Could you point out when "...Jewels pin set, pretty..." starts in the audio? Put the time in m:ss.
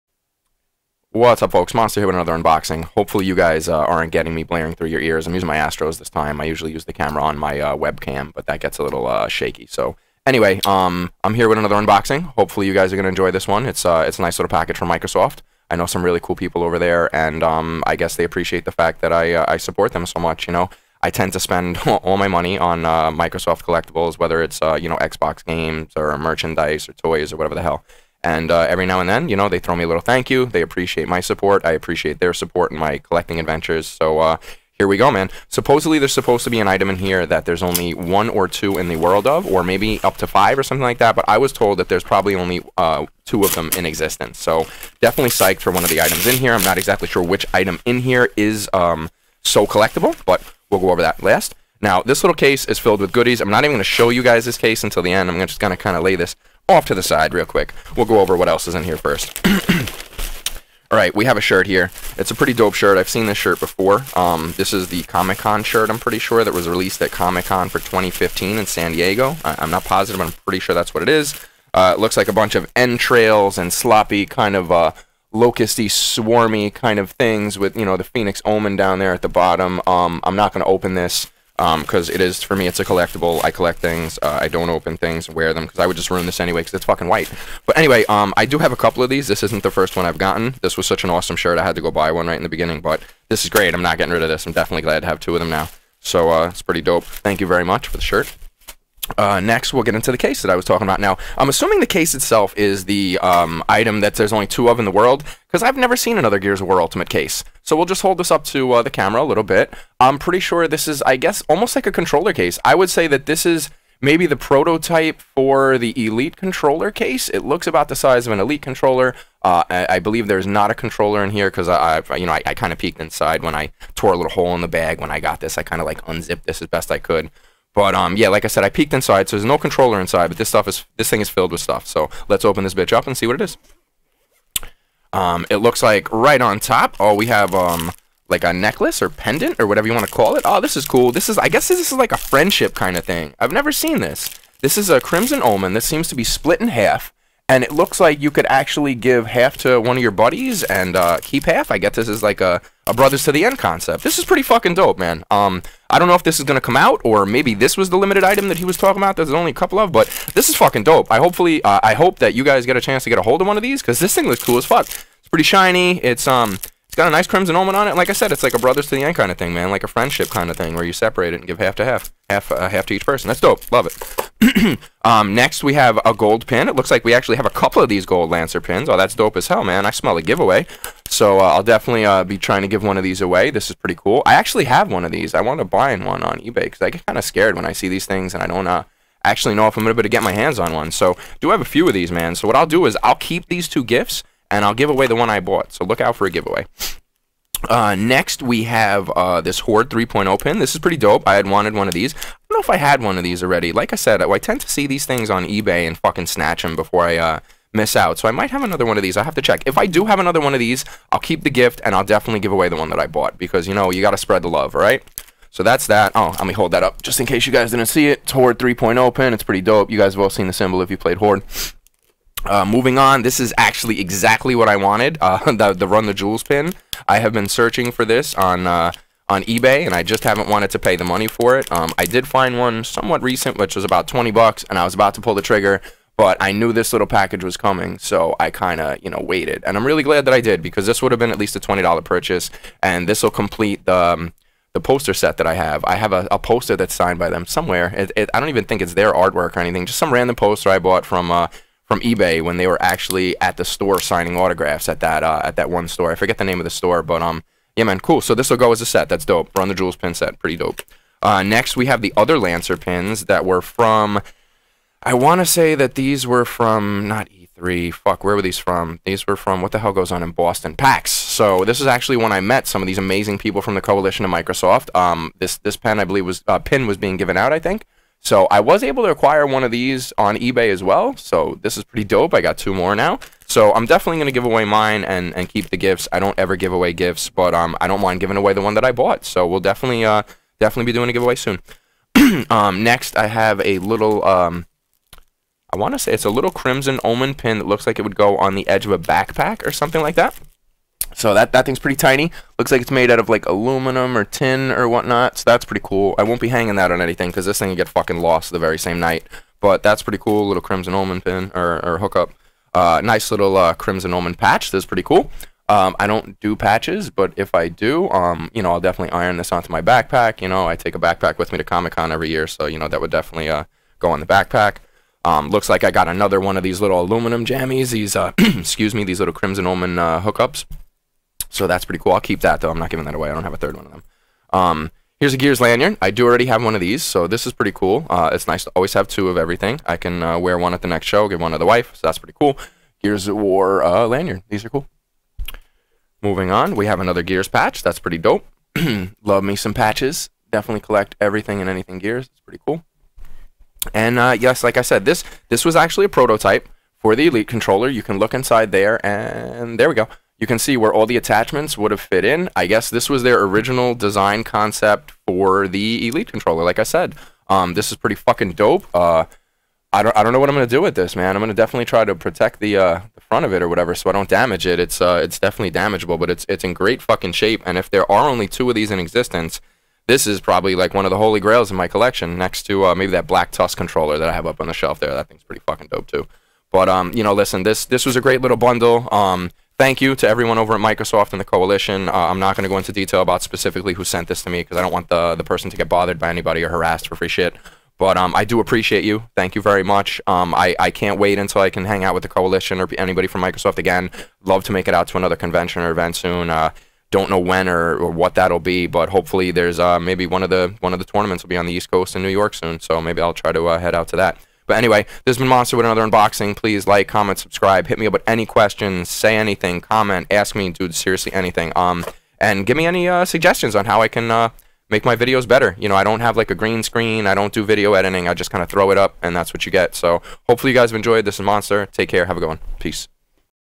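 4:19.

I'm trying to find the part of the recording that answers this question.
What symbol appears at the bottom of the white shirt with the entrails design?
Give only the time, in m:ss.
1:18.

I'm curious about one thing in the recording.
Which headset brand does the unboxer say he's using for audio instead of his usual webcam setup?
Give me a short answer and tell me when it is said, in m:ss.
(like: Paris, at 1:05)
Astros, at 0:05.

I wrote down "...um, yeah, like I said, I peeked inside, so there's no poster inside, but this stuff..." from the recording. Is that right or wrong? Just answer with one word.
wrong.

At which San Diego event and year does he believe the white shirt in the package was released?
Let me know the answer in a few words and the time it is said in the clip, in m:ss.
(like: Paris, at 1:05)
Comic Con 2015, at 1:07.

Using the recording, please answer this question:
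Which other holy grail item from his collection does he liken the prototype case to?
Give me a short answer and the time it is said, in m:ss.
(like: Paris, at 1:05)
Black Tusk controller, at 6:23.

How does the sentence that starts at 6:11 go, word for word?
I'm gonna definitely try to protect the uh, the front of it or whatever, so I don't damage it.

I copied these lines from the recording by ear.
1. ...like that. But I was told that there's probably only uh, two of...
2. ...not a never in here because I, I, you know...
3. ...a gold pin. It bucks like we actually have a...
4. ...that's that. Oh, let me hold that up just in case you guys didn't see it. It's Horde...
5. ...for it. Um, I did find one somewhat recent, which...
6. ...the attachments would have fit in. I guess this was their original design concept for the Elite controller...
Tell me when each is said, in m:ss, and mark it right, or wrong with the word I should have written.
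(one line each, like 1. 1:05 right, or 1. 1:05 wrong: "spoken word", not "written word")
1. 0:40 right
2. 2:00 wrong: "controller", not "never"
3. 2:56 wrong: "looks", not "bucks"
4. 3:35 right
5. 3:51 right
6. 6:01 right.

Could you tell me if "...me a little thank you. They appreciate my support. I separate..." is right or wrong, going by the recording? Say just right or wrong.
wrong.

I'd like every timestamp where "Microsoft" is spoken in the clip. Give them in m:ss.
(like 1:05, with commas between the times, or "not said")
0:14, 0:23, 4:34, 6:30, 6:43.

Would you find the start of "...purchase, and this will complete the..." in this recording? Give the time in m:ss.
4:02.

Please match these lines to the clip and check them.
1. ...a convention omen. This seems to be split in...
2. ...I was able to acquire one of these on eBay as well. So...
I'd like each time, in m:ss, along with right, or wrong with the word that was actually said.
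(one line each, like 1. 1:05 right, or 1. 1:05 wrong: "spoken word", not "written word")
1. 2:24 wrong: "crimson", not "convention"
2. 4:38 right.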